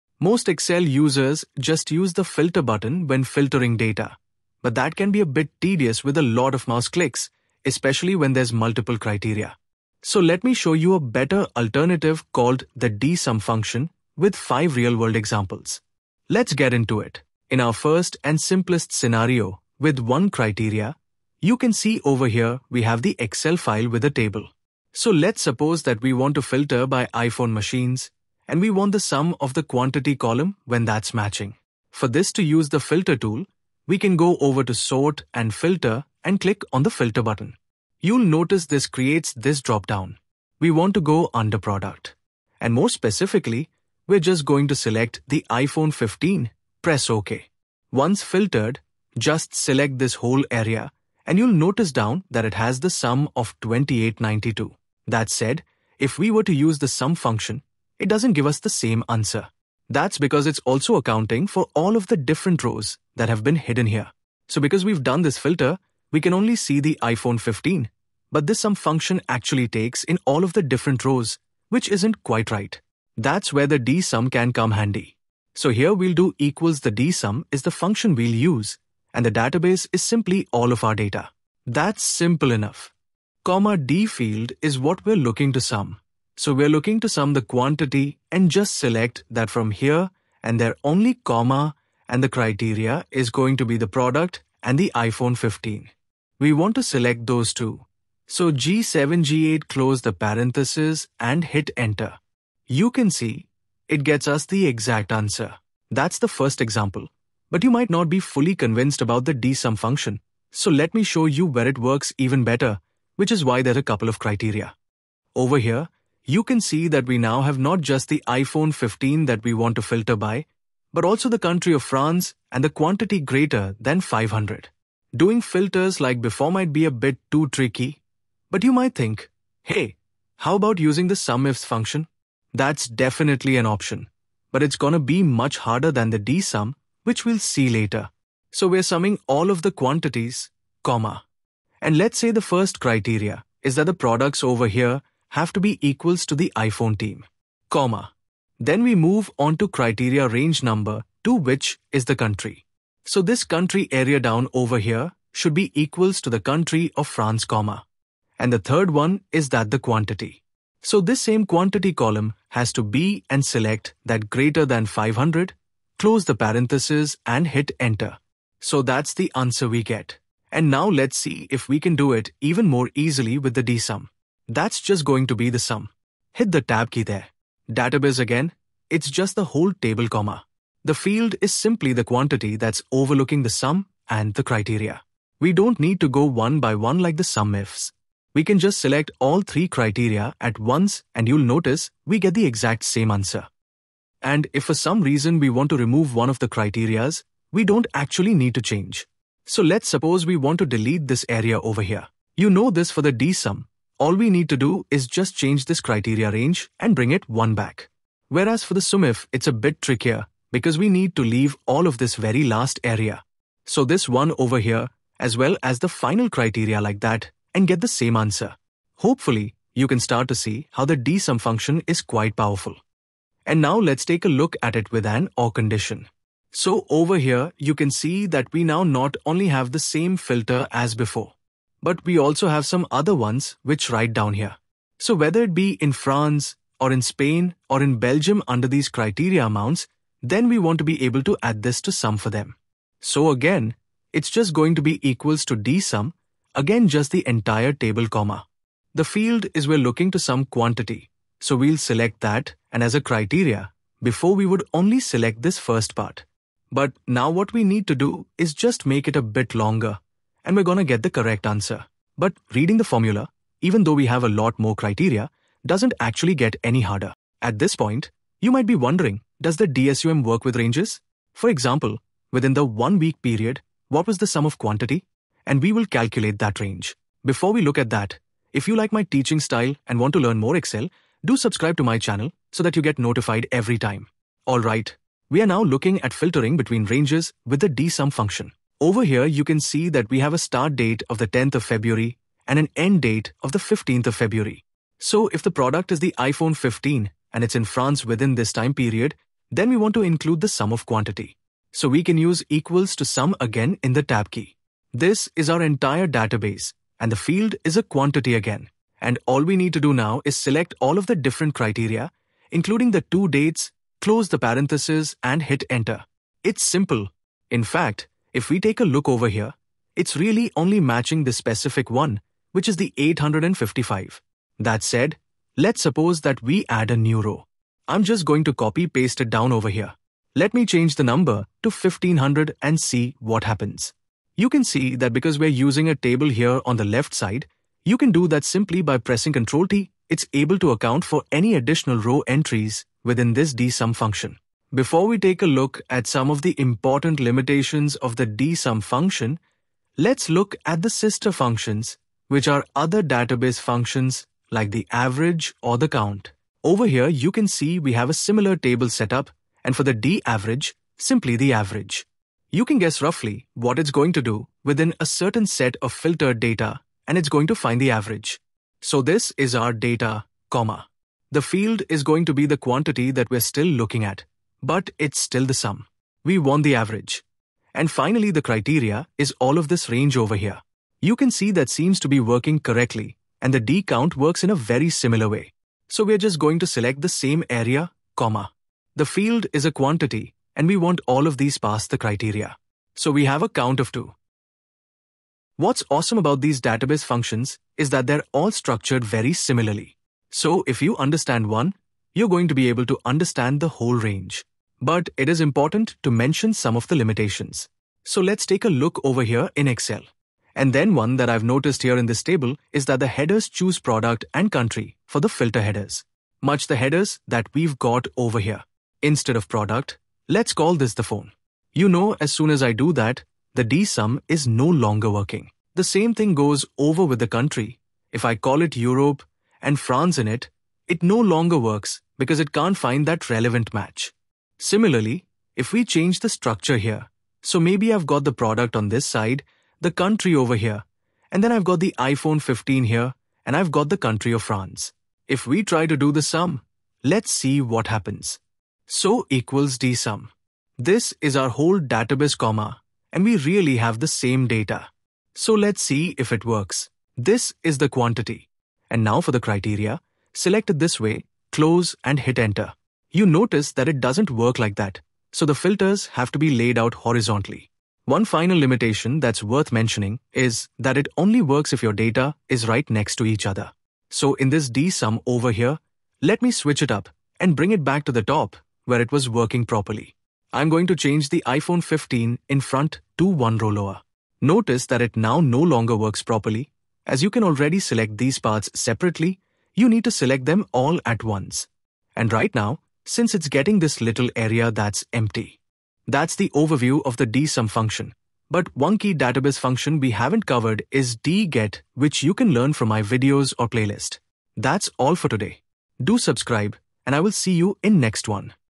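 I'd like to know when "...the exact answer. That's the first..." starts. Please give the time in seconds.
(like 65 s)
104 s.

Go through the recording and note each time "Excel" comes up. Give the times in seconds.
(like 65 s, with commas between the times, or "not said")
0 s, 23 s, 280 s, 409 s.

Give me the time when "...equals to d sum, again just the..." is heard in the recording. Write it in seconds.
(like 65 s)
245 s.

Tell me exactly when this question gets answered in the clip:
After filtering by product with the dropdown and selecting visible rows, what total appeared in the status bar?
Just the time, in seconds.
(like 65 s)
53 s.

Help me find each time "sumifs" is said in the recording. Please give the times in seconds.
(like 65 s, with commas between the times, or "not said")
131 s, 208 s.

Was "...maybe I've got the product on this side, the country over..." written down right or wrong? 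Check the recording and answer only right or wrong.
right.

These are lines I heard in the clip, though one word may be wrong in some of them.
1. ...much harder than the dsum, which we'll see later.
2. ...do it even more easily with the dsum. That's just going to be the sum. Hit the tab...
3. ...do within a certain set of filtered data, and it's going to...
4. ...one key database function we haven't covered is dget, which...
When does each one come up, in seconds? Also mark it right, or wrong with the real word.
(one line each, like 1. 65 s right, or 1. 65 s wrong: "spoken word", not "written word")
1. 135 s right
2. 171 s right
3. 364 s right
4. 498 s right.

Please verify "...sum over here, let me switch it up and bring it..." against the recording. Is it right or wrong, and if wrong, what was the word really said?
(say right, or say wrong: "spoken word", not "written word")
right.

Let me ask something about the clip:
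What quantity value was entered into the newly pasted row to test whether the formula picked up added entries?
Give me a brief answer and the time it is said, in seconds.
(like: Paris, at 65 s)
1500, at 331 s.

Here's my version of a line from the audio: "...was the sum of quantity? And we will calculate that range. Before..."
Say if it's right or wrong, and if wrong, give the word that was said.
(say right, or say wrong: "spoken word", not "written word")
right.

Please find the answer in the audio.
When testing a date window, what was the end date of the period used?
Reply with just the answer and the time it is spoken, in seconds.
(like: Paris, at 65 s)
15th of February, at 293 s.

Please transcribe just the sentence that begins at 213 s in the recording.
So this 1 over here, as well as the final criteria like that, and get the same answer.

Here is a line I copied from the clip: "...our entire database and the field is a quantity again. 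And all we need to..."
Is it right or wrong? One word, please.
right.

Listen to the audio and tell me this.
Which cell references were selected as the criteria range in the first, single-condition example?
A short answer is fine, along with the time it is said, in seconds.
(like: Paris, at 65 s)
G7, G8, at 98 s.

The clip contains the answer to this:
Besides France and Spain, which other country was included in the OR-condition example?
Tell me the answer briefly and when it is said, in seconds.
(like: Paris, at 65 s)
Belgium, at 237 s.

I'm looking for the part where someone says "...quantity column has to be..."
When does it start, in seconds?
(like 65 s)
161 s.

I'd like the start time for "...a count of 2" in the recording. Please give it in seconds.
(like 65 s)
393 s.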